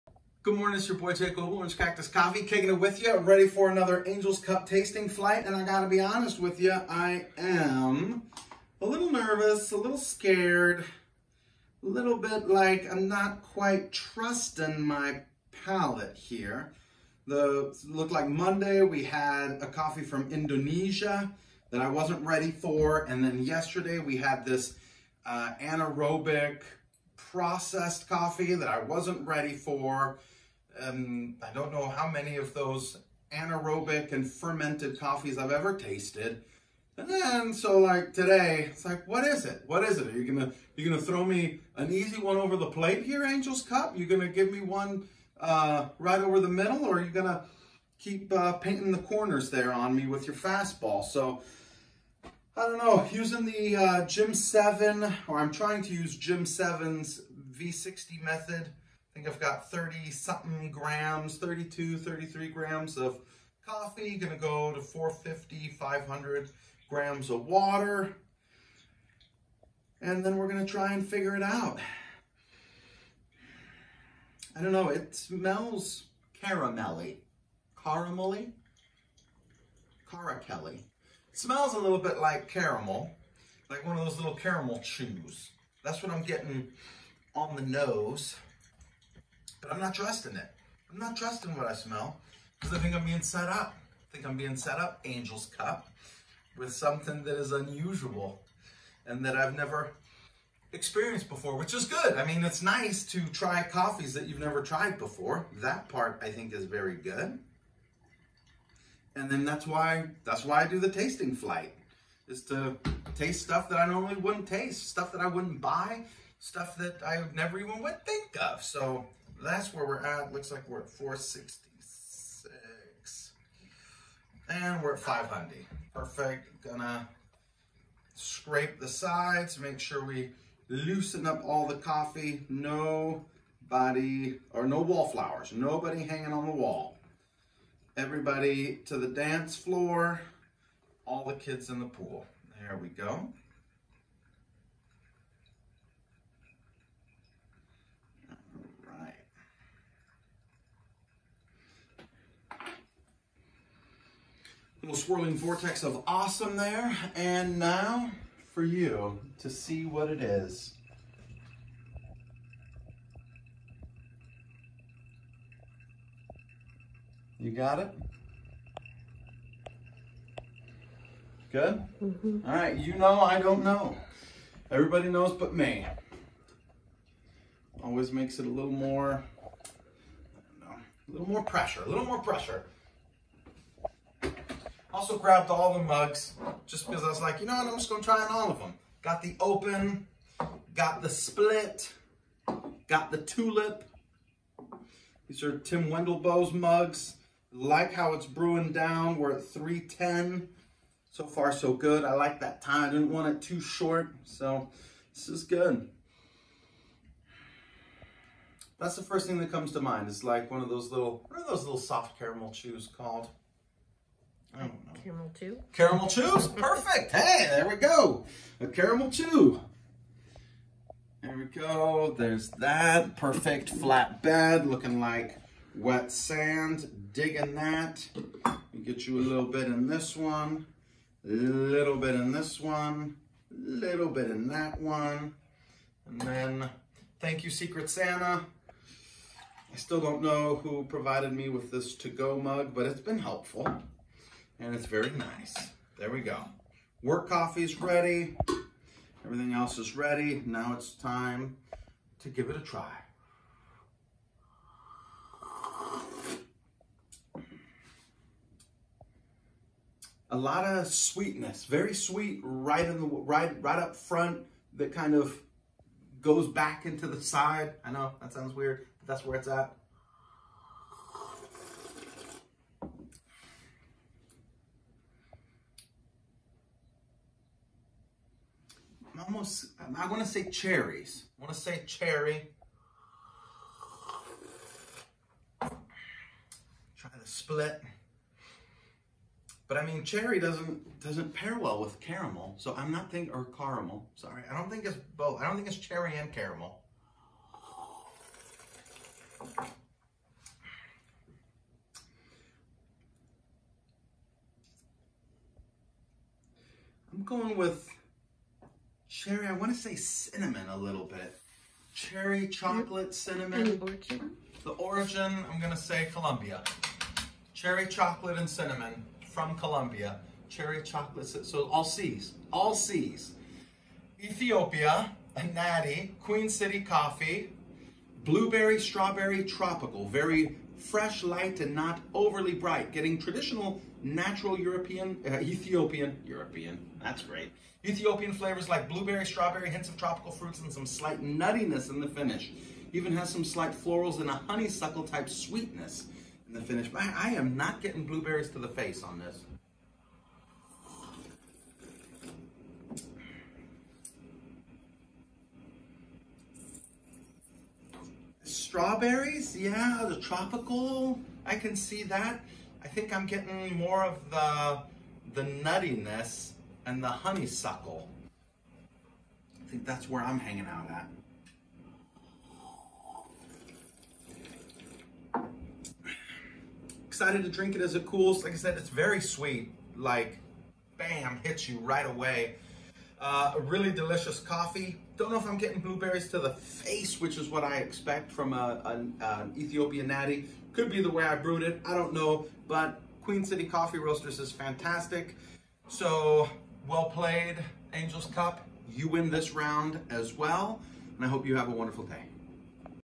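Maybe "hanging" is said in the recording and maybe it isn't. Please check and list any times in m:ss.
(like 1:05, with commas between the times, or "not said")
2:16, 6:10.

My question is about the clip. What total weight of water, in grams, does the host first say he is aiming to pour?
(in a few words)
450.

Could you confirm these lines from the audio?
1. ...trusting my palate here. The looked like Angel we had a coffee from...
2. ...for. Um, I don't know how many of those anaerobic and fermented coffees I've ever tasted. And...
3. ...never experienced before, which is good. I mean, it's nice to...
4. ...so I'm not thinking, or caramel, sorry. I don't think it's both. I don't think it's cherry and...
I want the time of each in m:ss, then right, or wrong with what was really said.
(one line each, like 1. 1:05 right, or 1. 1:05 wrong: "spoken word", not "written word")
1. 0:13 wrong: "Monday", not "Angel"
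2. 0:29 right
3. 1:39 right
4. 4:52 right.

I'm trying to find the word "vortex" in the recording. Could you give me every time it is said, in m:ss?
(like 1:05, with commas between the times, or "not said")
2:35.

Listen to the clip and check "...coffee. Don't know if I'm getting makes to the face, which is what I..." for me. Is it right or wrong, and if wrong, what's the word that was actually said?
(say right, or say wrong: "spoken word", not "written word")
wrong: "blueberries", not "makes".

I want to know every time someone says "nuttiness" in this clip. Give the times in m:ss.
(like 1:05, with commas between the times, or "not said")
5:41, 6:05.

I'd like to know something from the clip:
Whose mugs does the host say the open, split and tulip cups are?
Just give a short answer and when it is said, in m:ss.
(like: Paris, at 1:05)
Tim Wendelboe, at 3:15.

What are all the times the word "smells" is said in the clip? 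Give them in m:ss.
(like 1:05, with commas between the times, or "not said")
1:15, 1:21, 1:31.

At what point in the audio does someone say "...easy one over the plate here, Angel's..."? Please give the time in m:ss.
0:41.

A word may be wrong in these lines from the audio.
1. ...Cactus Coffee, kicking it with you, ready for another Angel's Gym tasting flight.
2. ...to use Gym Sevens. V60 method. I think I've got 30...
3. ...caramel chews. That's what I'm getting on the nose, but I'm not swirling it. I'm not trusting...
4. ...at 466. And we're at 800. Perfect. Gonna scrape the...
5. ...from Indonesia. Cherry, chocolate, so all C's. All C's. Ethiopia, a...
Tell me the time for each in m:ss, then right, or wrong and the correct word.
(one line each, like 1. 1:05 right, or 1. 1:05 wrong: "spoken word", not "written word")
1. 0:01 wrong: "Cup", not "Gym"
2. 0:55 right
3. 1:24 wrong: "trusting", not "swirling"
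4. 2:00 wrong: "500", not "800"
5. 5:19 wrong: "Colombia", not "Indonesia".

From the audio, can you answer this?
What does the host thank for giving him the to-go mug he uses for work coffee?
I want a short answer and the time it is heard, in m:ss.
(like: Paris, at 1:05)
Secret Santa, at 3:57.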